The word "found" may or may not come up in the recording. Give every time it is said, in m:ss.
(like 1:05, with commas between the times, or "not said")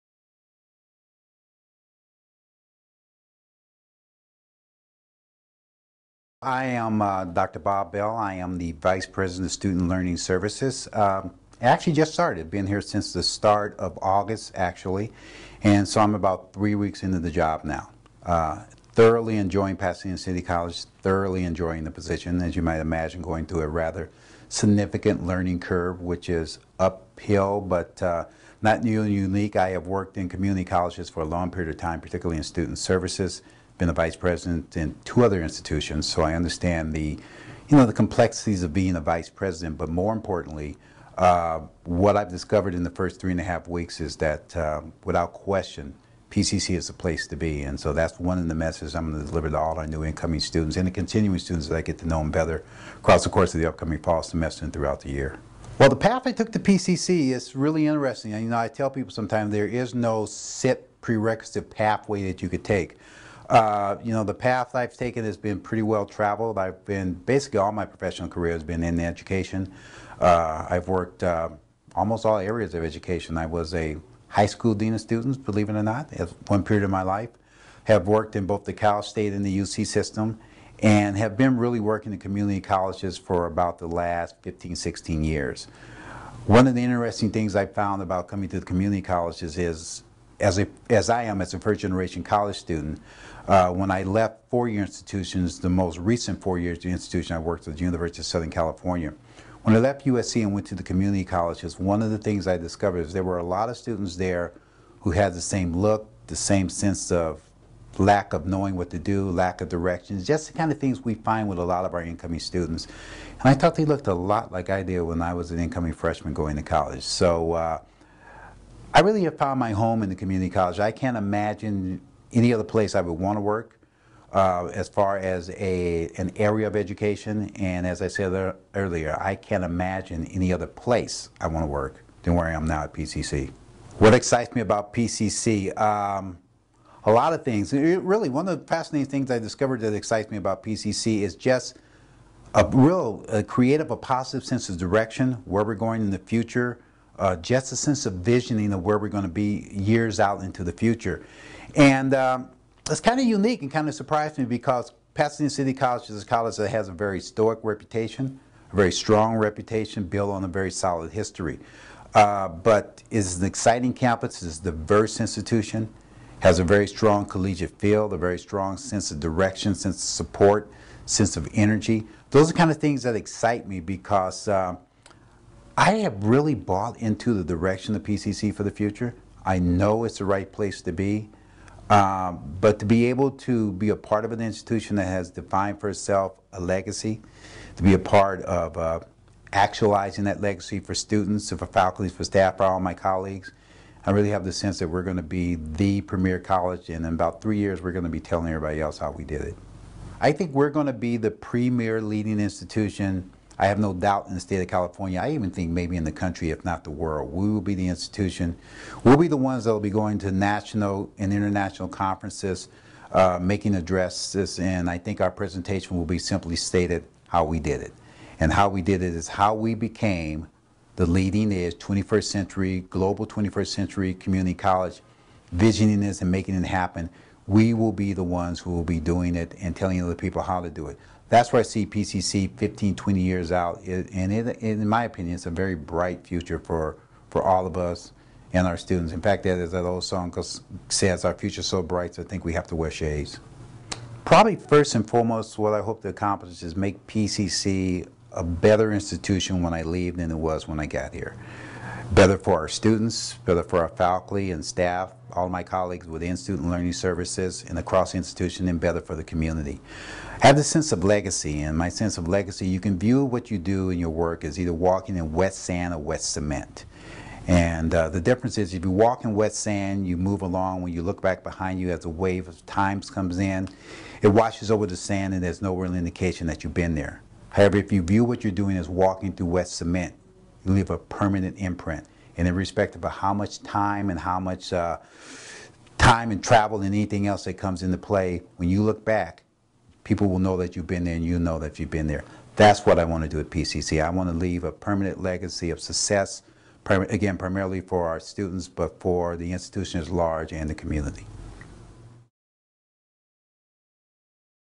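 1:27, 1:59.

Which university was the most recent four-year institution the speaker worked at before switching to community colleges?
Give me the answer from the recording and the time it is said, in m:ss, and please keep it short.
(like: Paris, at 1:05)
University of Southern California, at 1:37.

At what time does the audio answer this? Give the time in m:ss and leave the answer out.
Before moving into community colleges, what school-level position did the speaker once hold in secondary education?
1:14.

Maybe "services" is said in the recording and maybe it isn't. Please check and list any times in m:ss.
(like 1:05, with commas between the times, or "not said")
0:10, 0:32, 4:16.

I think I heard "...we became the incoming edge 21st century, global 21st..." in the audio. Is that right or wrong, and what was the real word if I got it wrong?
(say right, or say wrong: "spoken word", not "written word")
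wrong: "leading", not "incoming".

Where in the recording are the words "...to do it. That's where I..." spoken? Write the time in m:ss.
3:50.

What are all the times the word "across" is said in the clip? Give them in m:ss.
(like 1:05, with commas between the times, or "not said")
0:52, 4:17.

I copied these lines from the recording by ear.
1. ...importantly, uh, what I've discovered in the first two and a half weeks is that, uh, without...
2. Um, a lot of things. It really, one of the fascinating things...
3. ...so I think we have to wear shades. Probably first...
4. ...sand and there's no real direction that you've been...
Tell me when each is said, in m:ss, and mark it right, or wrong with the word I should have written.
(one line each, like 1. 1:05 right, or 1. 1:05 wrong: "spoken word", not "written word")
1. 0:40 wrong: "three", not "two"
2. 2:15 right
3. 4:02 right
4. 4:34 wrong: "indication", not "direction".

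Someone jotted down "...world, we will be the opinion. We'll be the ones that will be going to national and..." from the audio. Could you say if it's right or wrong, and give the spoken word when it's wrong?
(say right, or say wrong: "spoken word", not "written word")
wrong: "institution", not "opinion".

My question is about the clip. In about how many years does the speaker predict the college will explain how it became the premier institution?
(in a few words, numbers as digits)
3 years.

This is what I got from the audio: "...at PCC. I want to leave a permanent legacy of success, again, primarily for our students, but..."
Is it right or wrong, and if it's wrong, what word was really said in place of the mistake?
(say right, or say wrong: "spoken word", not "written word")
right.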